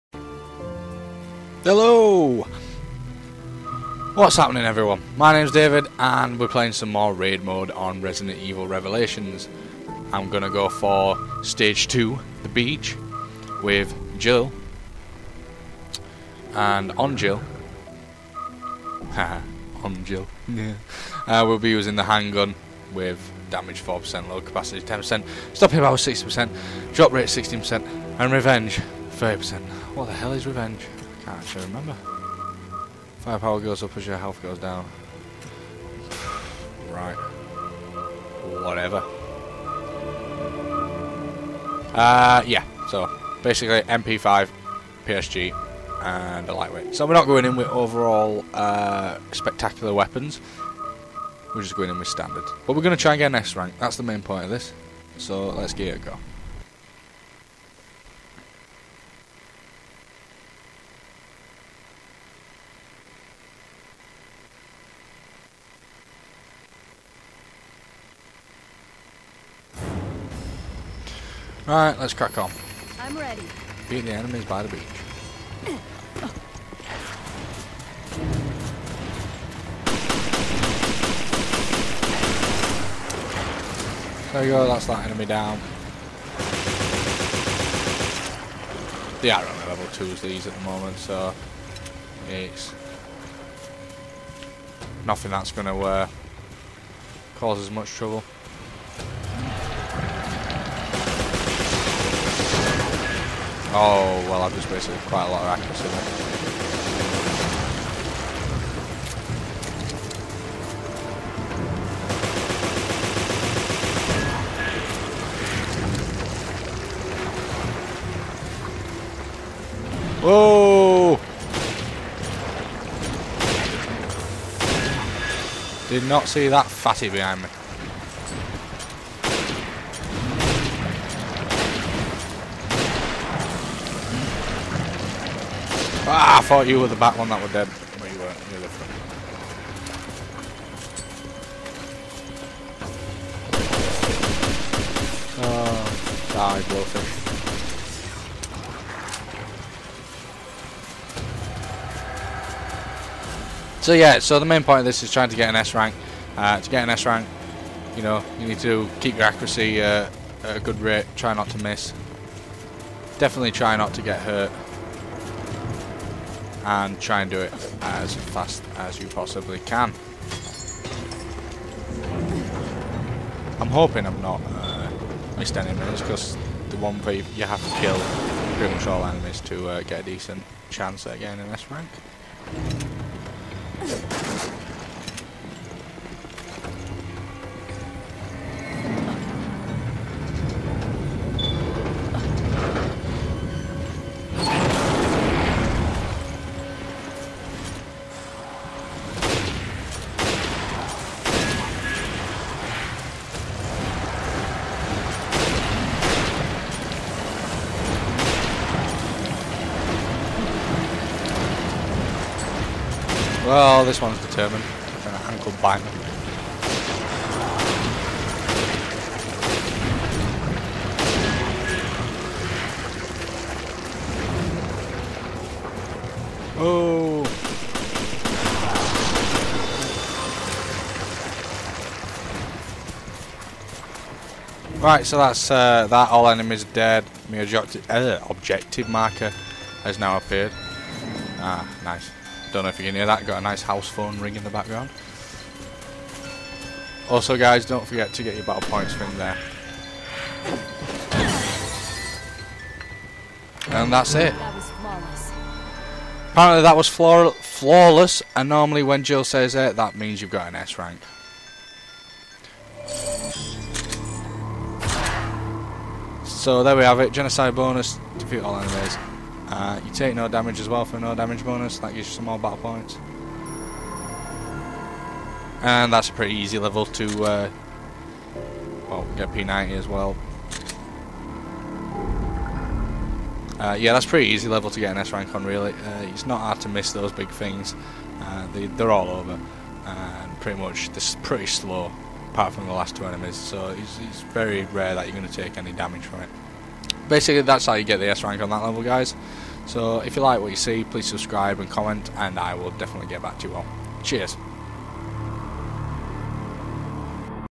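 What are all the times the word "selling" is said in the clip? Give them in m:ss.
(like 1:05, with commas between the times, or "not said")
not said.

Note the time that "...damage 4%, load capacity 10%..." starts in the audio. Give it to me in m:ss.
0:23.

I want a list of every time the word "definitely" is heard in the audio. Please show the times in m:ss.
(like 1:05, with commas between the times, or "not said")
2:43, 5:02.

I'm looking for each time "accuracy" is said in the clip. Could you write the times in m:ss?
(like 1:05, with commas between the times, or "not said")
1:45, 2:39.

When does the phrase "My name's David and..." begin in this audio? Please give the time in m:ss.
0:05.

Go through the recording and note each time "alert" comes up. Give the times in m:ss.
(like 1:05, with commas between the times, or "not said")
not said.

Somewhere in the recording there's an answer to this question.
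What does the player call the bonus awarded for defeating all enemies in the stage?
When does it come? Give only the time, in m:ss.
4:27.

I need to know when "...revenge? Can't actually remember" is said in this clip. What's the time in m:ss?
0:30.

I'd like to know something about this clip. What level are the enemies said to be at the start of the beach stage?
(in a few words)
2.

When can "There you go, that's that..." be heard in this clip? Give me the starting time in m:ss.
1:24.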